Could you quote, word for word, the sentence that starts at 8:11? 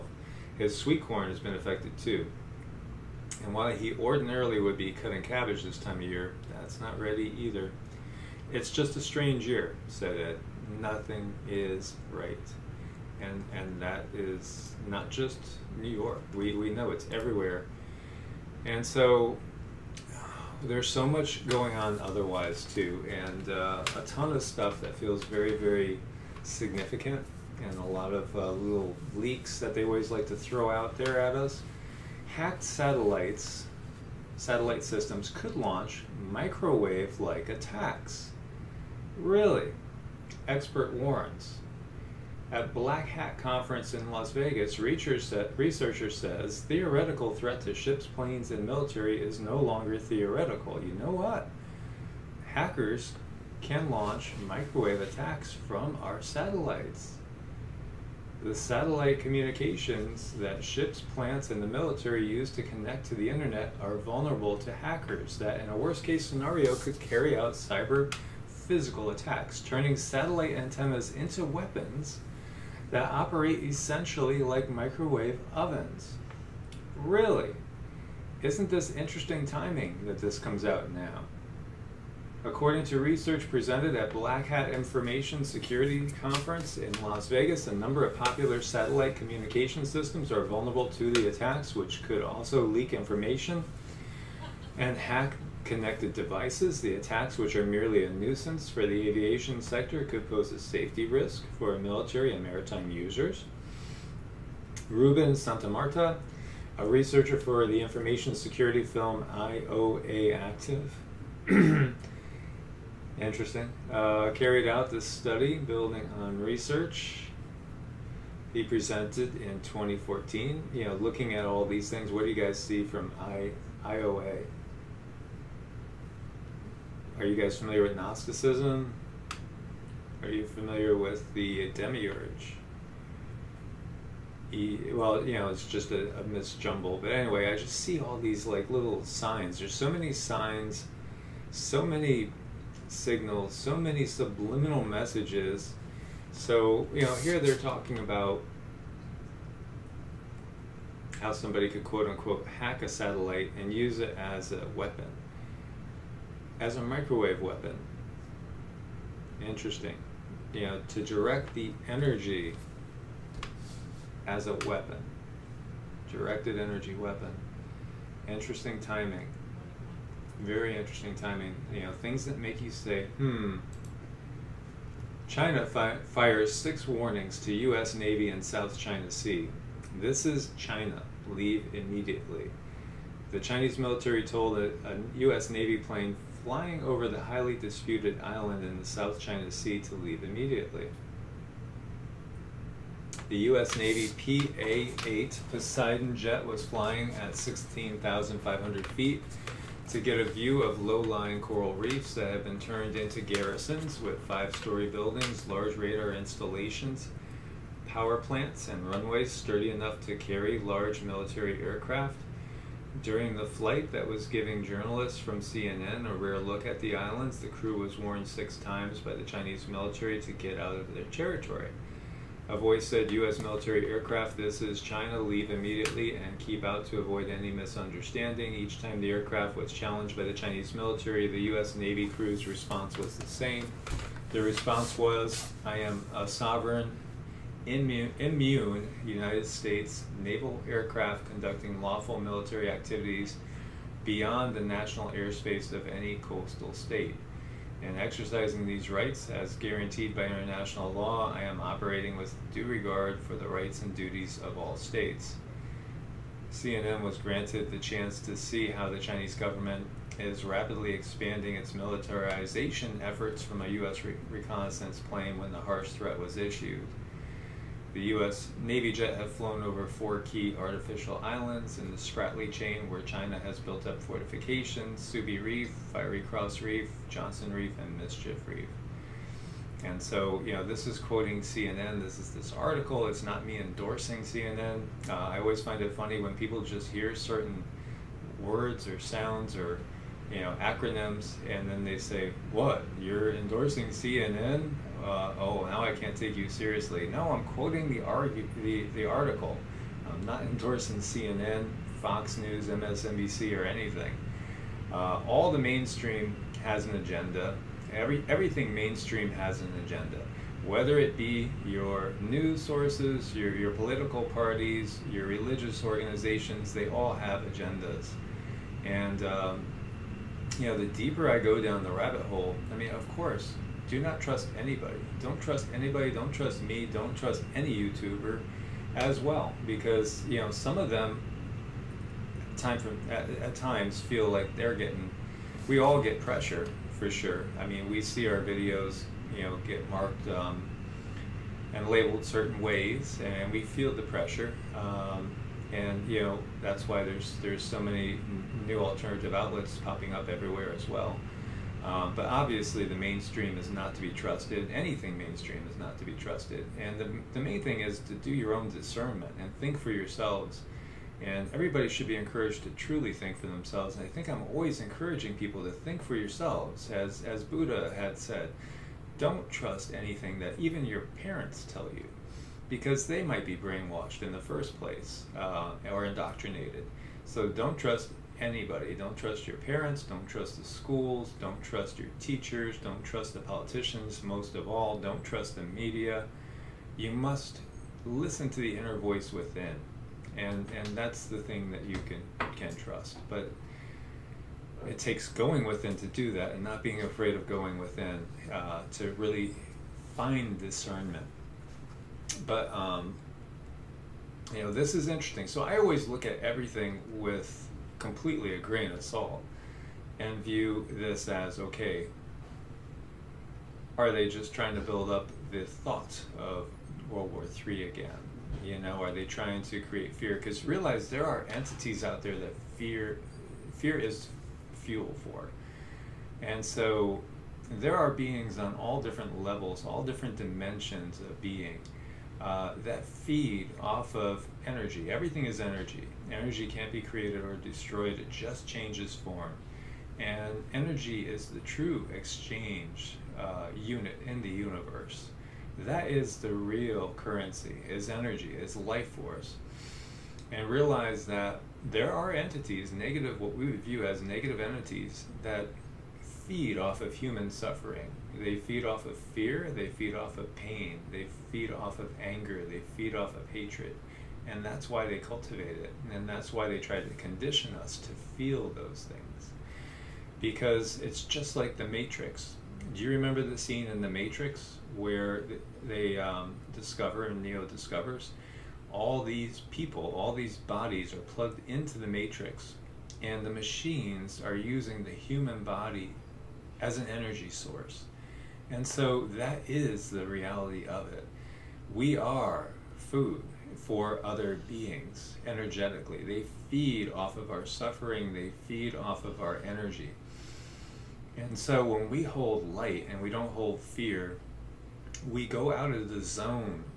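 We are food for other beings energetically.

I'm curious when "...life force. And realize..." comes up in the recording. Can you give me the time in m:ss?
7:28.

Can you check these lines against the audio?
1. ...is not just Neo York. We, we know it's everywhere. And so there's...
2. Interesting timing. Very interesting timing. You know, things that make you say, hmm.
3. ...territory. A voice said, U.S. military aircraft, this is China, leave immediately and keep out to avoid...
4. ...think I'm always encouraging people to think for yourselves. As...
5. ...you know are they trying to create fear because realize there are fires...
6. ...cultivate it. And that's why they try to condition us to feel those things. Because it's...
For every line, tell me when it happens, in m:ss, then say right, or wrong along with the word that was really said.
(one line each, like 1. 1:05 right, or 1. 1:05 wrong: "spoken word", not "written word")
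1. 0:14 wrong: "New", not "Neo"
2. 2:48 right
3. 3:41 right
4. 6:04 right
5. 6:58 wrong: "entities", not "fires"
6. 7:45 right.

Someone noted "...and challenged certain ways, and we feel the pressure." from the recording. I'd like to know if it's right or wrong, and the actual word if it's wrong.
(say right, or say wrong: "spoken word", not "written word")
wrong: "labeled", not "challenged".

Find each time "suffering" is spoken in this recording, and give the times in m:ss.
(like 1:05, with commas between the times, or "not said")
7:37, 8:17.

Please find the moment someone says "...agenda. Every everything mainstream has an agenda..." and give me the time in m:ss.
5:06.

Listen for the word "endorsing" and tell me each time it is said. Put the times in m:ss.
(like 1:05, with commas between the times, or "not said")
4:43, 4:53, 5:00.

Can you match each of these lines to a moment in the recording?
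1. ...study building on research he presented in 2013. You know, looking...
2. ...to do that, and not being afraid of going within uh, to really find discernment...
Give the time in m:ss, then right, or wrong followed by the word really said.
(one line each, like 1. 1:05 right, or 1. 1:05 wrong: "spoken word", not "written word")
1. 1:55 wrong: "2014", not "2013"
2. 6:35 right.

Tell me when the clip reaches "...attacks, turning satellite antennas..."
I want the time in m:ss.
1:09.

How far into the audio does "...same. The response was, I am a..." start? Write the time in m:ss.
3:53.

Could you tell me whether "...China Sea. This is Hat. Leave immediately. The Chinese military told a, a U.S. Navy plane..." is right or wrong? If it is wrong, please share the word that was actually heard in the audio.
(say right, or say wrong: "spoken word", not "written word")
wrong: "China", not "Hat".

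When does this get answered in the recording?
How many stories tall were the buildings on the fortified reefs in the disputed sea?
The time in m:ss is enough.
3:24.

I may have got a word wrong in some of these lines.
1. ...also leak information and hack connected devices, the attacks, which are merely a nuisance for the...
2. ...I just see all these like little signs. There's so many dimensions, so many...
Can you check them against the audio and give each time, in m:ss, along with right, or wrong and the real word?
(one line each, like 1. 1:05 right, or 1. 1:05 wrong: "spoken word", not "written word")
1. 1:32 right
2. 2:17 wrong: "signs", not "dimensions".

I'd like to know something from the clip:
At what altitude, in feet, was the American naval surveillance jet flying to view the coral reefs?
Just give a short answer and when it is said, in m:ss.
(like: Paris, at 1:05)
16,500 feet, at 3:17.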